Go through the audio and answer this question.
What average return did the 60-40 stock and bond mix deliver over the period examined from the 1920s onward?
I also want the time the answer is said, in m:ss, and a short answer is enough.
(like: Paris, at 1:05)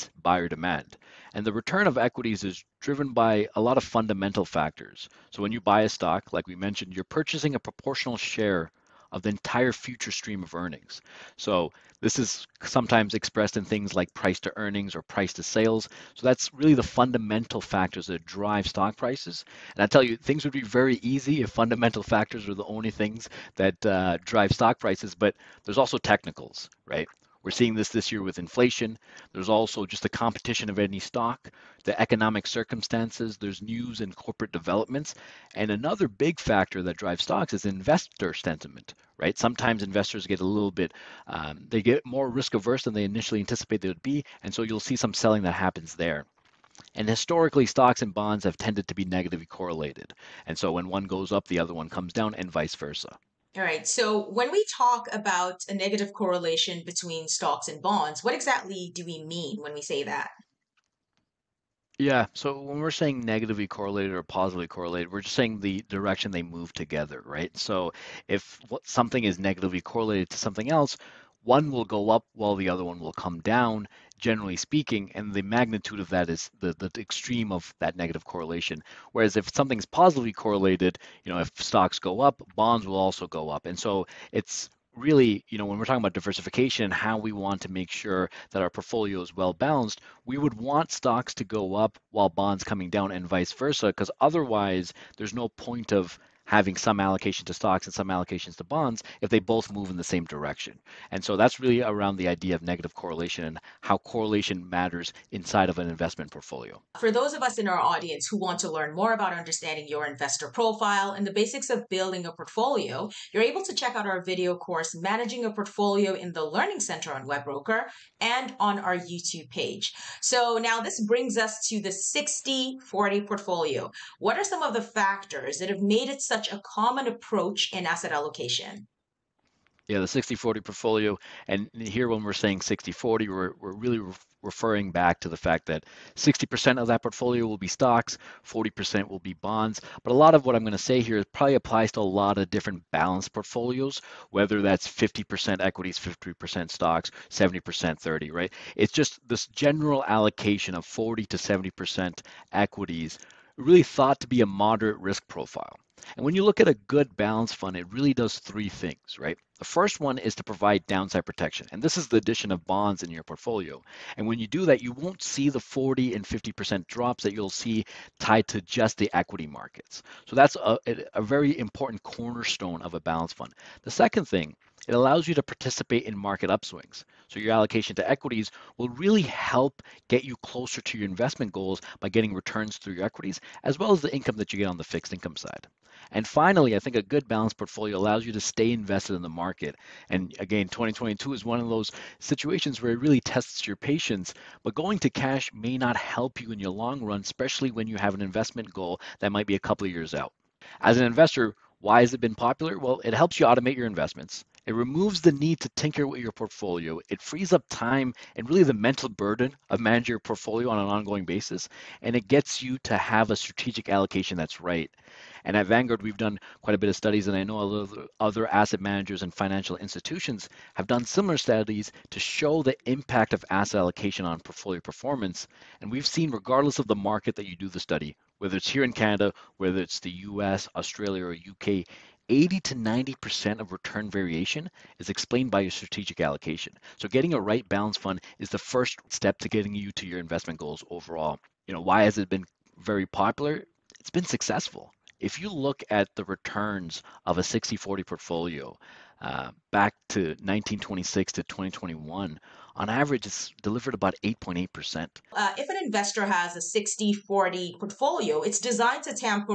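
8.8%, at 4:14.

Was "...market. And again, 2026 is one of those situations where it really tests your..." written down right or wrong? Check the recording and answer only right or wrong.
wrong.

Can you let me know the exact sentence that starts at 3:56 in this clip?
So getting a right balance fund is the first step to getting you to your investment goals overall.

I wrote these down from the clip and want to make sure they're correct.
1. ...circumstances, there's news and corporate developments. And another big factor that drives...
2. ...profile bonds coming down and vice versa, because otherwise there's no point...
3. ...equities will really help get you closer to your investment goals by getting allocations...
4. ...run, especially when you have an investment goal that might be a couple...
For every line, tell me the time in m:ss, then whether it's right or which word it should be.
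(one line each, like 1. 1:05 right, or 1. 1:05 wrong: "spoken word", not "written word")
1. 0:32 right
2. 1:32 wrong: "while", not "profile"
3. 2:58 wrong: "returns", not "allocations"
4. 3:17 right.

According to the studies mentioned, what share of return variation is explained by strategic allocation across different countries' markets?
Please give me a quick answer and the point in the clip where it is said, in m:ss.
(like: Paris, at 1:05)
80 to 90%, at 3:52.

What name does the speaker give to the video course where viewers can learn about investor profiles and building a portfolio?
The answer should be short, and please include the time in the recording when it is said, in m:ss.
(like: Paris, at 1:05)
Managing a Portfolio, at 1:54.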